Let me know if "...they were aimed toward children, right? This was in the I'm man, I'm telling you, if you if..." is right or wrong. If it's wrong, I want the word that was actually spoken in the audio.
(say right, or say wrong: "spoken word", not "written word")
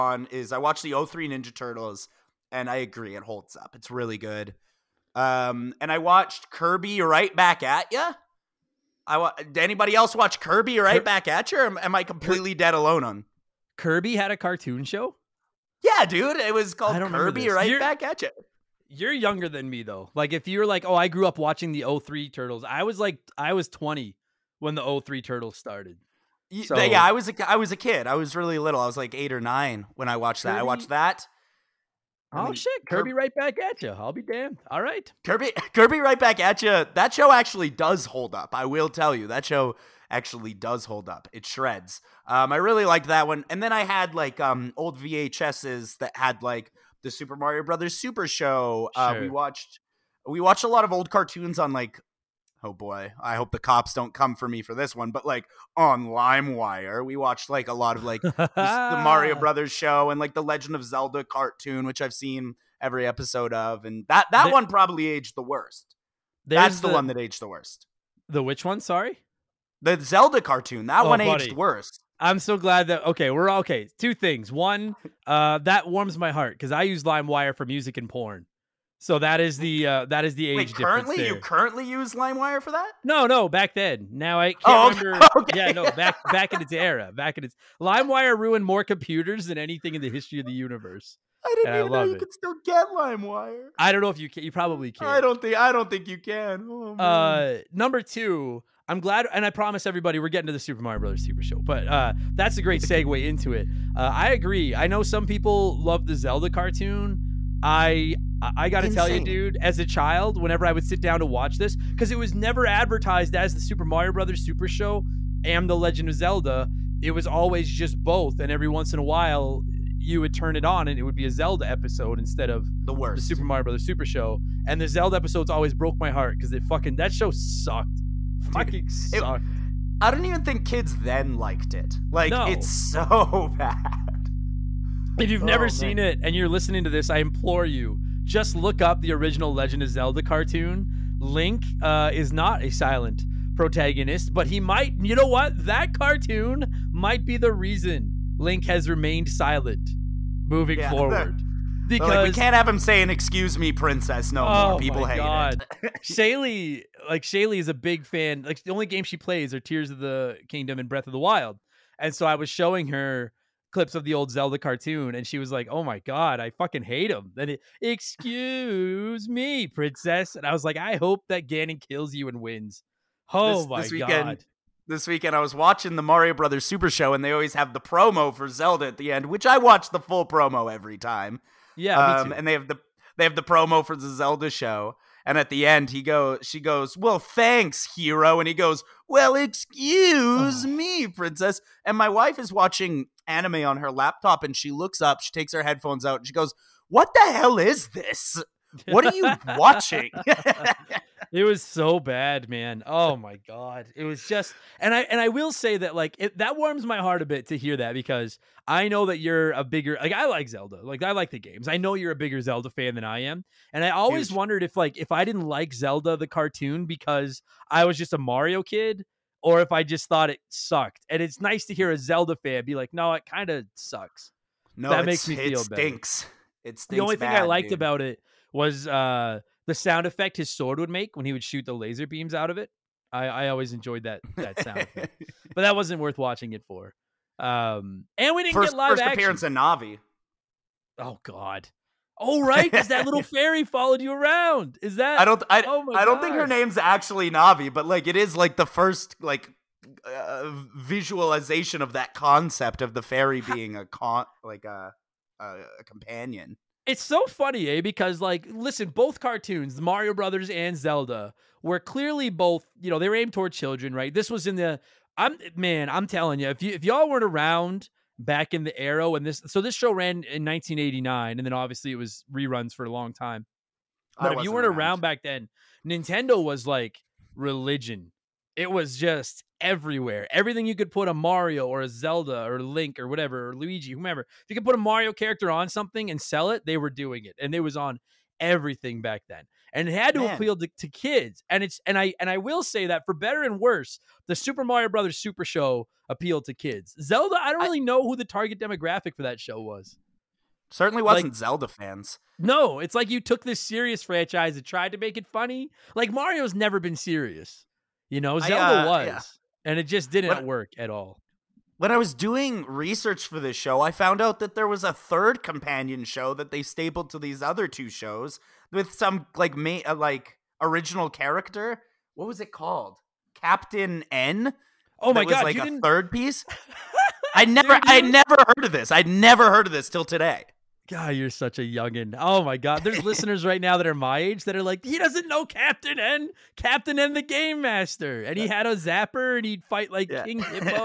right.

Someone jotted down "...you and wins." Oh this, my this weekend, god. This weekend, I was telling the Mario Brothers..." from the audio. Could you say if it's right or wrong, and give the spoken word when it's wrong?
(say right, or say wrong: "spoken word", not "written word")
wrong: "watching", not "telling".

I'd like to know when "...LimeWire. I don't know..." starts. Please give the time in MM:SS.
01:32.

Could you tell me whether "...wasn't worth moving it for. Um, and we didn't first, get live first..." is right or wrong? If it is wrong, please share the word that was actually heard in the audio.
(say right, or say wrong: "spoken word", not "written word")
wrong: "watching", not "moving".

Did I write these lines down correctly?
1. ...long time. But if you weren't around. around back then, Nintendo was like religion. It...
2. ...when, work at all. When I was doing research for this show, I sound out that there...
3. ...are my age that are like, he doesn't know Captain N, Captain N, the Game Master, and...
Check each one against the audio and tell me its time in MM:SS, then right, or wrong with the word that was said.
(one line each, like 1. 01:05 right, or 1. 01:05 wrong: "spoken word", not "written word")
1. 04:32 right
2. 05:10 wrong: "found", not "sound"
3. 05:33 right.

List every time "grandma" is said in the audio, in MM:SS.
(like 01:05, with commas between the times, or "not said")
not said.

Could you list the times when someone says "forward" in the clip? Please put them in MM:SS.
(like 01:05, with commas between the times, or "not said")
02:30.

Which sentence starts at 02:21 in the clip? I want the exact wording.
Link uh, is not a silent protagonist, but he might, you know what?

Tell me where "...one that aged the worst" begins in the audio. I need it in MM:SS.
01:06.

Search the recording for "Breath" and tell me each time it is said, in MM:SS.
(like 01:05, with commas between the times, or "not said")
02:40.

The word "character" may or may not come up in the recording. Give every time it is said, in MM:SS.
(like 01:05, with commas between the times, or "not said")
04:45, 05:21.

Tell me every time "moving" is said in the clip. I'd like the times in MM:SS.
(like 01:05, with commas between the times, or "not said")
02:30.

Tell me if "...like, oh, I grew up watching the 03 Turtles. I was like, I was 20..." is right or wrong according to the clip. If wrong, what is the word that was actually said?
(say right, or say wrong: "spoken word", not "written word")
right.